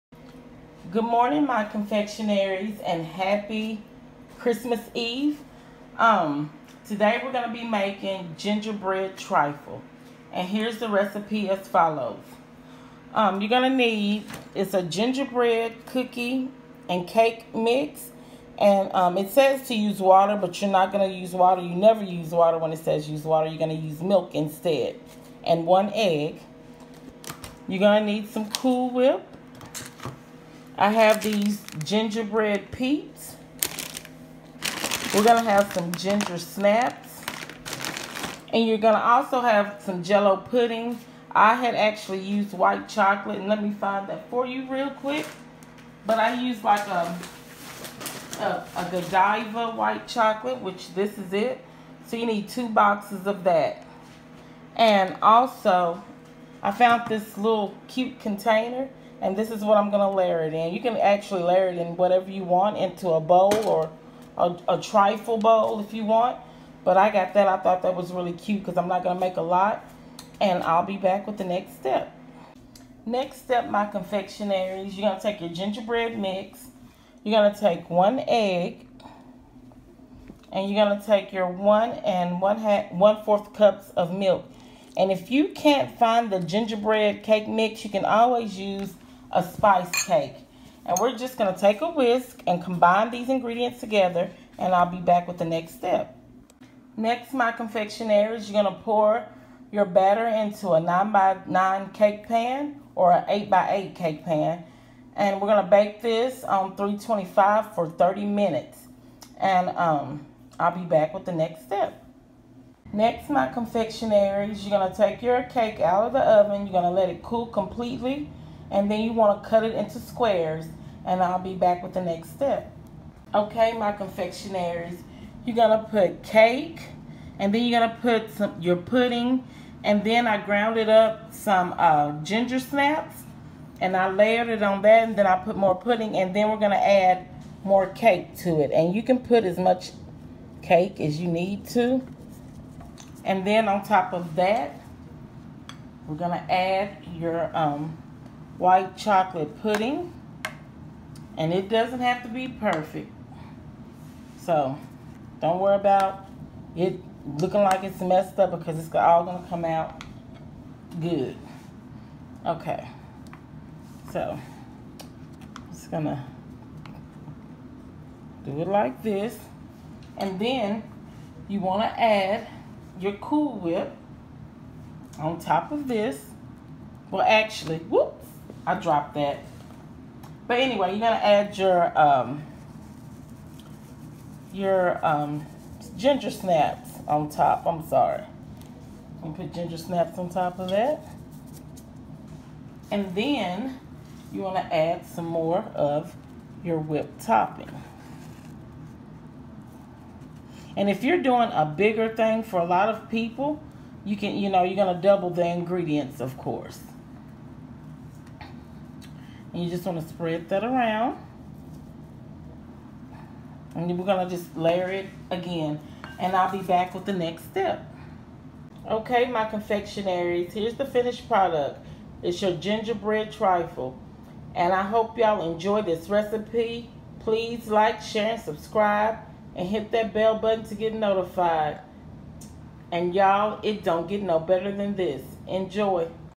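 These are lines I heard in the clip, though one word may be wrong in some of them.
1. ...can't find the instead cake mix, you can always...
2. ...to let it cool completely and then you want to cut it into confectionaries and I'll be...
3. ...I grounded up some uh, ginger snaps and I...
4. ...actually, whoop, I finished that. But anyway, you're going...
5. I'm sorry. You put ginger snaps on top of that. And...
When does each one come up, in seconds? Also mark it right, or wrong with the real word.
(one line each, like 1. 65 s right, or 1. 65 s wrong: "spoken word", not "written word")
1. 85 s wrong: "gingerbread", not "instead"
2. 116 s wrong: "squares", not "confectionaries"
3. 130 s right
4. 177 s wrong: "dropped", not "finished"
5. 187 s right.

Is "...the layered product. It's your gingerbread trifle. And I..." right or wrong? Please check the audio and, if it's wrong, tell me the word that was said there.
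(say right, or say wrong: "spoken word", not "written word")
wrong: "finished", not "layered".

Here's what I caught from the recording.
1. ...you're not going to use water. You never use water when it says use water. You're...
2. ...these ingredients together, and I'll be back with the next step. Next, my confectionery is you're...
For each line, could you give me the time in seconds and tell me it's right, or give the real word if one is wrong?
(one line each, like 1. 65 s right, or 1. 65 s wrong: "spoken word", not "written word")
1. 20 s right
2. 93 s right.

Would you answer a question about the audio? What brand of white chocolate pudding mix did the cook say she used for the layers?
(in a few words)
Godiva.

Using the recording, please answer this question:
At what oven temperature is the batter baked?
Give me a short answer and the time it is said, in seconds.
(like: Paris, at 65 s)
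325, at 106 s.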